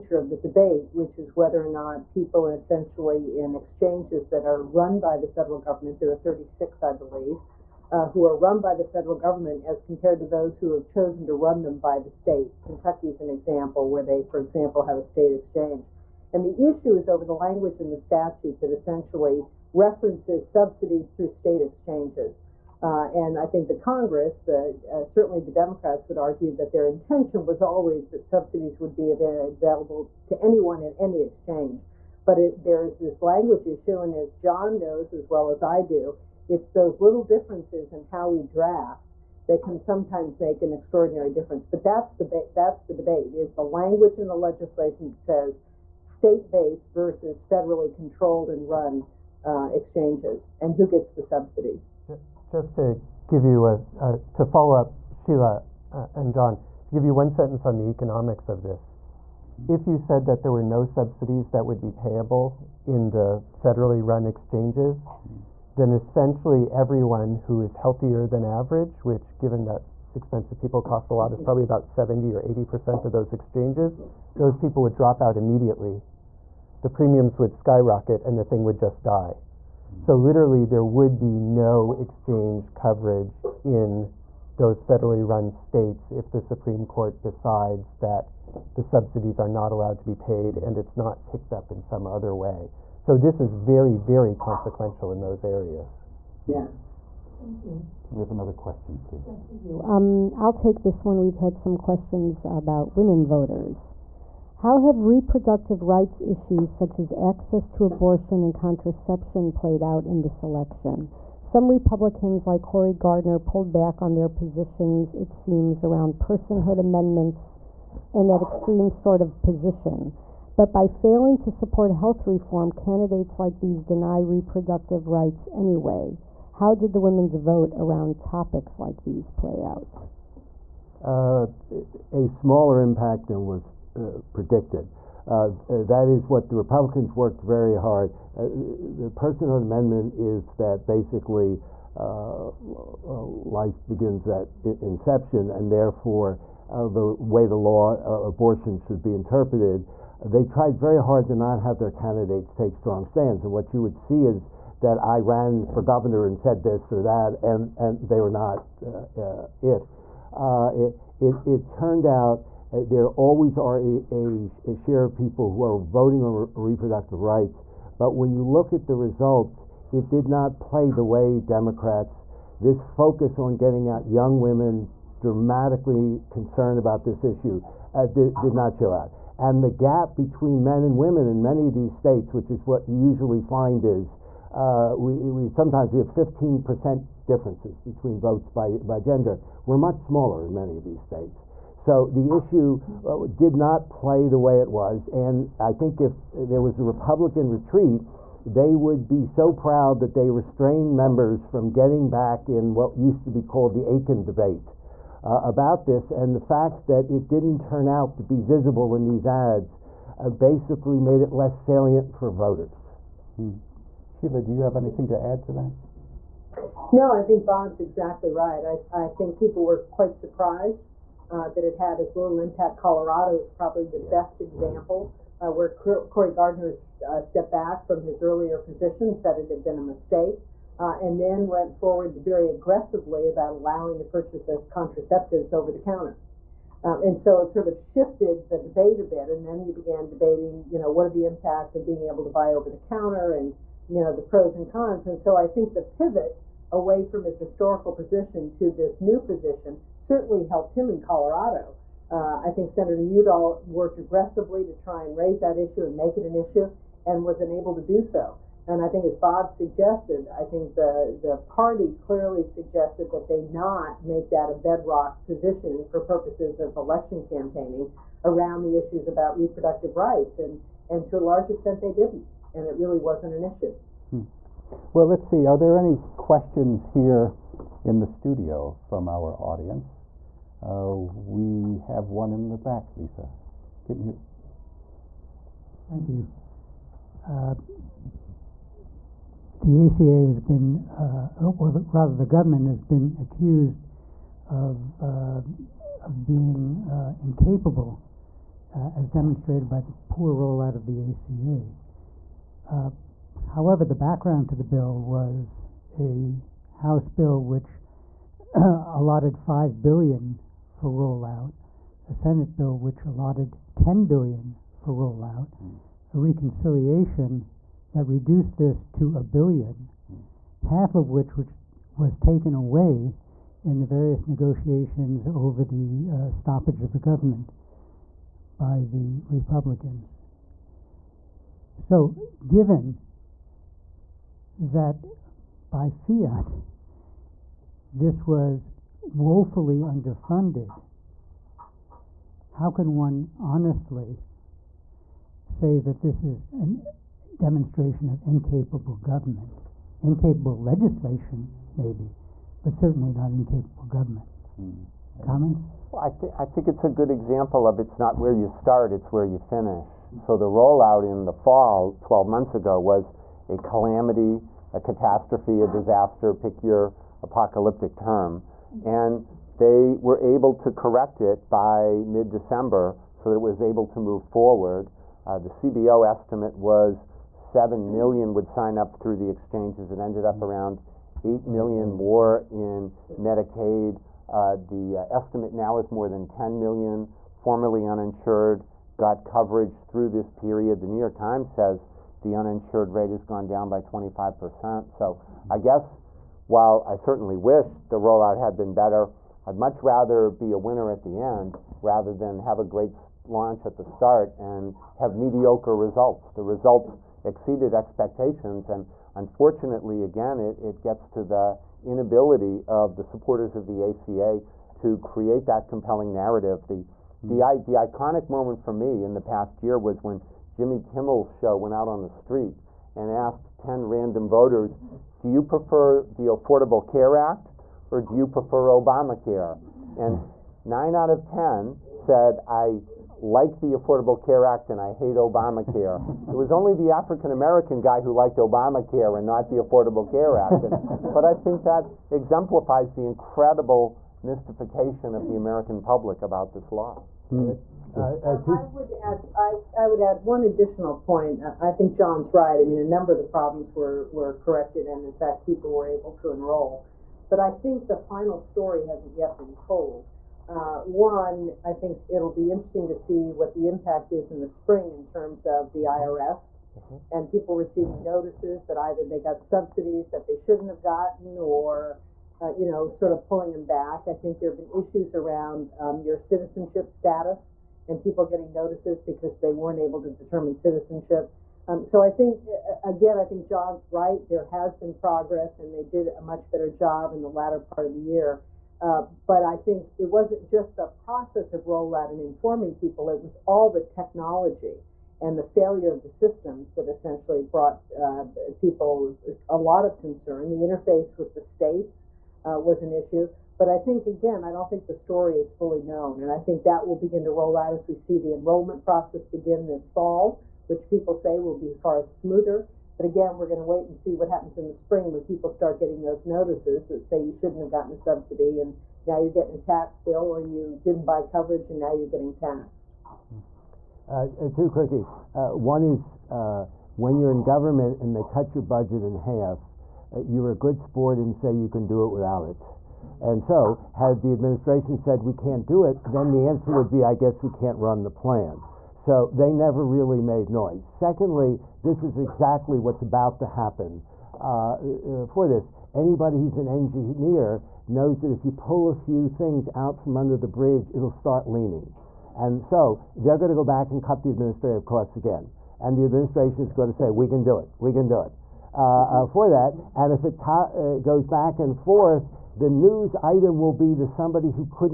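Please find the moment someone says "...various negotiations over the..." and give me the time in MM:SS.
05:23.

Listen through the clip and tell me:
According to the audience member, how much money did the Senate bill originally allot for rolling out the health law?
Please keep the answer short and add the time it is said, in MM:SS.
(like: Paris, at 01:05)
10 billion, at 05:13.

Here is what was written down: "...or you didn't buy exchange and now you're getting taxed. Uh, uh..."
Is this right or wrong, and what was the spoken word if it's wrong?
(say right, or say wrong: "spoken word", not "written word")
wrong: "coverage", not "exchange".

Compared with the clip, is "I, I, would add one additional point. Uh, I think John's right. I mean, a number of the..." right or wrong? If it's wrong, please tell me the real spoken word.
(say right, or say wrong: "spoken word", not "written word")
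right.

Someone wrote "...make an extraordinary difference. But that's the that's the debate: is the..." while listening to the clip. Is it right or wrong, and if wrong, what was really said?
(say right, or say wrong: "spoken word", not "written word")
right.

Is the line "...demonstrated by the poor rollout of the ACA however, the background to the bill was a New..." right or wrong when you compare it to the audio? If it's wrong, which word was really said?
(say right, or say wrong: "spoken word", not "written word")
wrong: "House", not "New".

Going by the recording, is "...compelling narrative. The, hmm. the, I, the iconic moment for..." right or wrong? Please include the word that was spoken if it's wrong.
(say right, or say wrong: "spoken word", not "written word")
right.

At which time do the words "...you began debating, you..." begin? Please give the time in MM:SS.
03:59.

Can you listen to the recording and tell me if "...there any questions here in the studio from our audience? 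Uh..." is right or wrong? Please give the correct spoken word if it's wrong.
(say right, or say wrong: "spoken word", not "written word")
right.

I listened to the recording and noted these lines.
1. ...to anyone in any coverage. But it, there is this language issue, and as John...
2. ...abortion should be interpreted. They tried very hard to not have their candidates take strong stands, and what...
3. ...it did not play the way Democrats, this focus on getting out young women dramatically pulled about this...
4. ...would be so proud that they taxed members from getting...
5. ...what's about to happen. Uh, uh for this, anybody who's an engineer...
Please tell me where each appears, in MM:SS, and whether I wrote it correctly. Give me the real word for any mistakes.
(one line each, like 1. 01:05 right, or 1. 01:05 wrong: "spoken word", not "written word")
1. 00:30 wrong: "exchange", not "coverage"
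2. 02:28 right
3. 02:49 wrong: "concerned", not "pulled"
4. 03:18 wrong: "restrained", not "taxed"
5. 09:02 right.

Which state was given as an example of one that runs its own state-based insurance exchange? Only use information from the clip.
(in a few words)
Kentucky.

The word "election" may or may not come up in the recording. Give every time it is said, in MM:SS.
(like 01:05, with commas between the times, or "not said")
01:50, 04:26.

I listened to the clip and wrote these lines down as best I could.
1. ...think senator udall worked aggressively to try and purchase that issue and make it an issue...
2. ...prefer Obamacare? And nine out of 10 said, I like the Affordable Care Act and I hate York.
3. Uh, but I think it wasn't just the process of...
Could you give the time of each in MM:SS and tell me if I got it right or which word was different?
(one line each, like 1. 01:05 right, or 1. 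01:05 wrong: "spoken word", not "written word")
1. 04:12 wrong: "raise", not "purchase"
2. 07:08 wrong: "Obamacare", not "York"
3. 08:08 right.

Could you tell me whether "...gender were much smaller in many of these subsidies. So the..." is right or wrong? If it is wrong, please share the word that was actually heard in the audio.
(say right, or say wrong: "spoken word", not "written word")
wrong: "states", not "subsidies".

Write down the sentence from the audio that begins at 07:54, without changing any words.
I think there have been issues around um, your citizenship status and people getting notices because they weren't able to determine citizenship.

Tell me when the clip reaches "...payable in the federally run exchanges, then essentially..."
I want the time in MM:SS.
01:01.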